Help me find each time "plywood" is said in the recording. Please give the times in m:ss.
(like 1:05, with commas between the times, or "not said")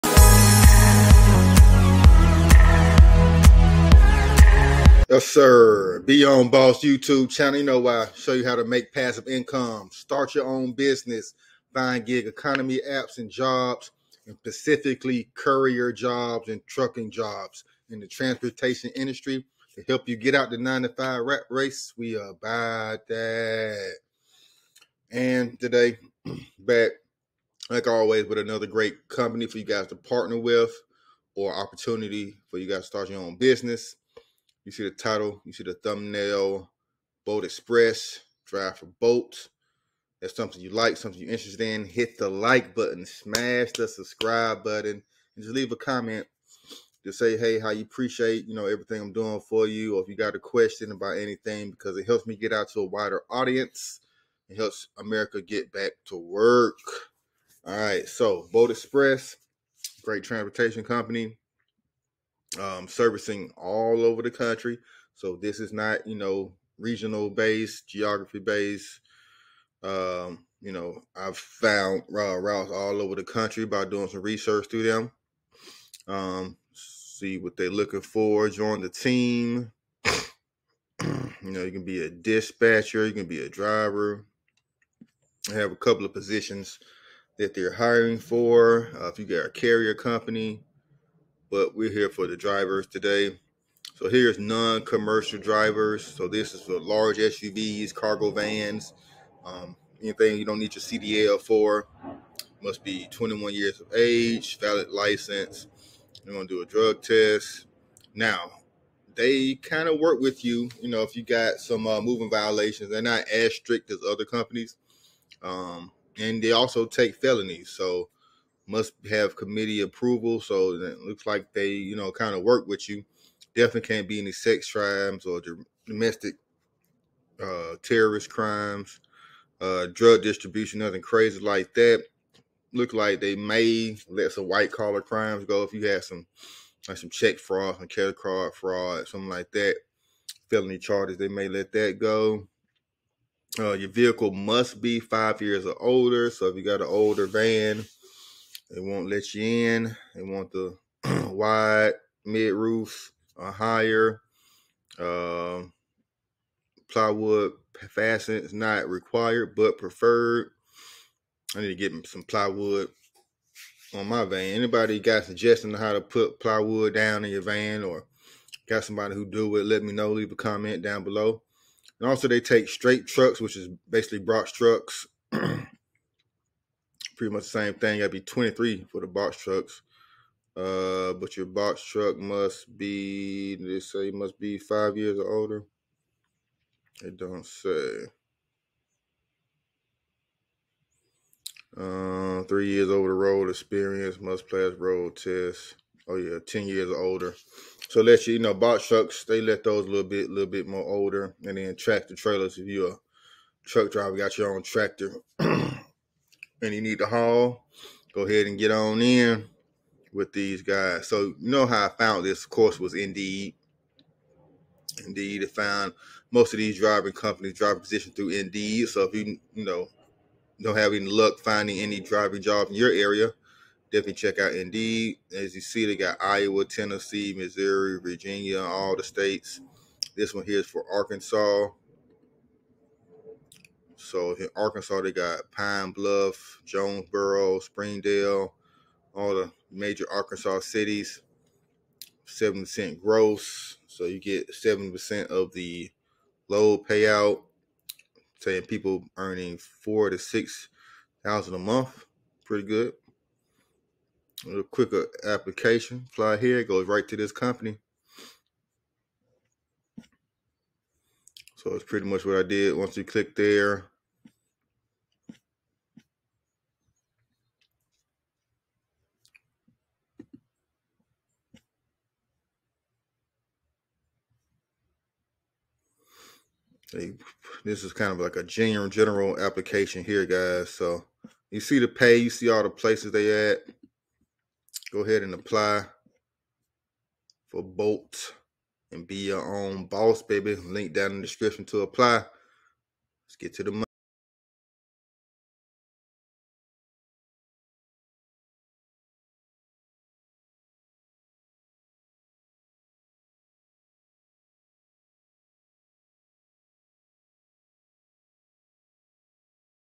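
2:36, 2:42, 2:46.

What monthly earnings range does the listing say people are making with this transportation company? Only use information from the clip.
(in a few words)
4,000 to 6,000.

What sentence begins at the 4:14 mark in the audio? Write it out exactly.
A little quicker application, fly here, goes right to this company.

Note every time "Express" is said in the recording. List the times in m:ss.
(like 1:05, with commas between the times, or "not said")
0:37, 0:58.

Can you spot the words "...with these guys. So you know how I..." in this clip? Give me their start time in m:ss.
3:30.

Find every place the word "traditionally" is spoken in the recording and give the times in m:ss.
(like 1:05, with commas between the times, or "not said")
not said.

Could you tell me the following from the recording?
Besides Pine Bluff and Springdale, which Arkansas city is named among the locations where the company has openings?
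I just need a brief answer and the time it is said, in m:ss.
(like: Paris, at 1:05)
Jonesboro, at 3:56.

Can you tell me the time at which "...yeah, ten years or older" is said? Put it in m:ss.
3:16.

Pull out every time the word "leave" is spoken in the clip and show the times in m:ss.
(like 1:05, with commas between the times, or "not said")
0:45, 2:50.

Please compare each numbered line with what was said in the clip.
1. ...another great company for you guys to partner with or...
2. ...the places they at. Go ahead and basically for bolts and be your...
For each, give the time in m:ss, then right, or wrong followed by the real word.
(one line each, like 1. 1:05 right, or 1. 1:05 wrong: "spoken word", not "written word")
1. 0:28 right
2. 4:42 wrong: "apply", not "basically".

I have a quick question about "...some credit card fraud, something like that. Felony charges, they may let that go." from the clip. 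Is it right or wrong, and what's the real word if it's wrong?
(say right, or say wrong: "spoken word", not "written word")
right.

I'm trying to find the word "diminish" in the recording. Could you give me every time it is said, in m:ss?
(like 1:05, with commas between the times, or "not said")
not said.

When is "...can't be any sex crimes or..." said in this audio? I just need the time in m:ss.
2:03.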